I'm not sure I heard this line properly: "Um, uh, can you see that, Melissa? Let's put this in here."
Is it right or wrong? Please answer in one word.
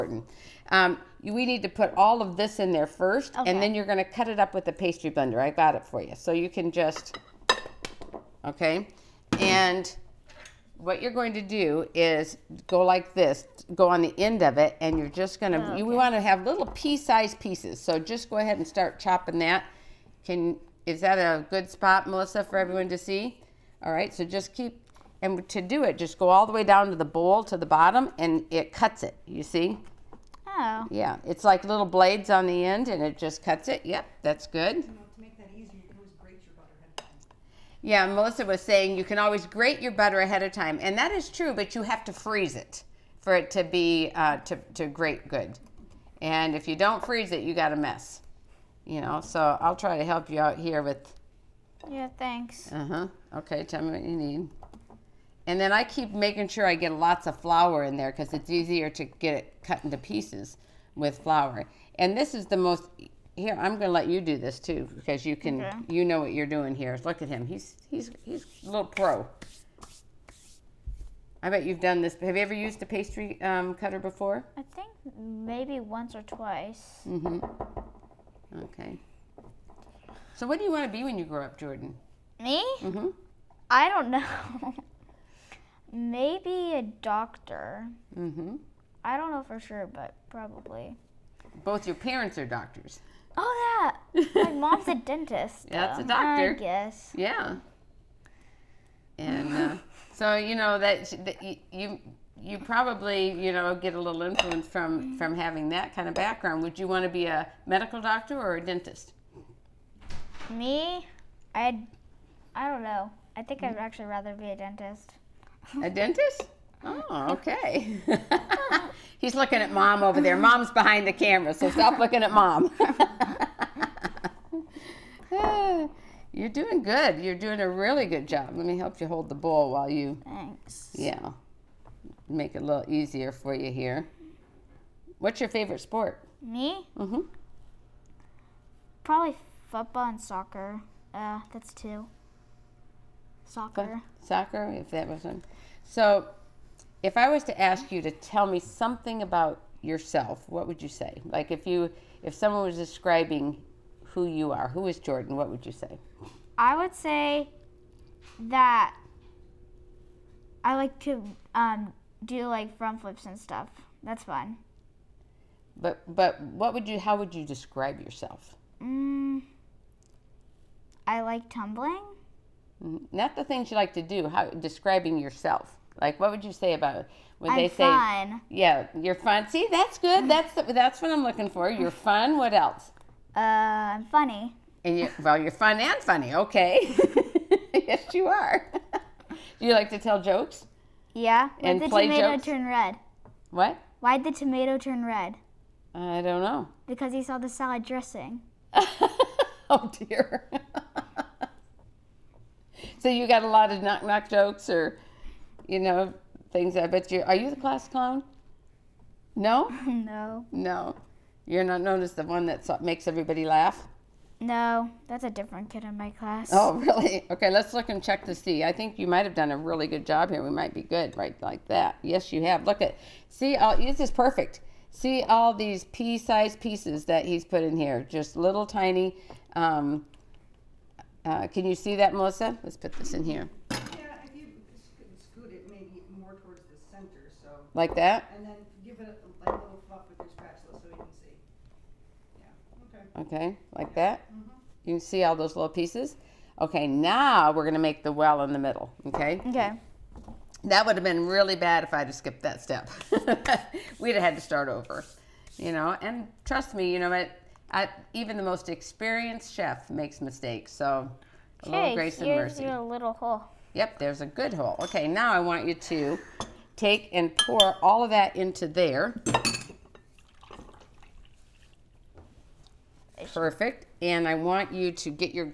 right.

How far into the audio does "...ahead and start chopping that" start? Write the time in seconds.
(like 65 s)
18 s.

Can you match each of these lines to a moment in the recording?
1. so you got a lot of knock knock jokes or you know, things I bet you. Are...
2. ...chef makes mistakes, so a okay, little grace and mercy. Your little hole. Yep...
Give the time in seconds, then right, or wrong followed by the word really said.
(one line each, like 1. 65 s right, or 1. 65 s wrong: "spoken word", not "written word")
1. 202 s right
2. 259 s right.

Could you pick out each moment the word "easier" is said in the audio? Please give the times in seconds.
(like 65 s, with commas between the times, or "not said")
58 s, 132 s.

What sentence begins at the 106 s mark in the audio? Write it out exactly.
Would you want to be a medical doctor or a dentist?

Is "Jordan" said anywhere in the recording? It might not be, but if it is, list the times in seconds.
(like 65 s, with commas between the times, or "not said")
81 s, 154 s.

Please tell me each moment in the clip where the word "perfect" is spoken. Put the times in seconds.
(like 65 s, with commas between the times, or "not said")
224 s, 273 s.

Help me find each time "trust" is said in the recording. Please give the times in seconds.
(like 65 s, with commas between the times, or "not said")
256 s.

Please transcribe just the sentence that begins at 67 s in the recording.
Look at him, he's, he's, he's a little pro.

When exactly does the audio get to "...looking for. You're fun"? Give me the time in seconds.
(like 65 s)
181 s.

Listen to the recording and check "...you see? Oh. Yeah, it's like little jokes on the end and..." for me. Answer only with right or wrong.
wrong.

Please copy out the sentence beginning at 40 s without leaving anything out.
And that is true, but you have to freeze it for it to be, uh, to, to grate good.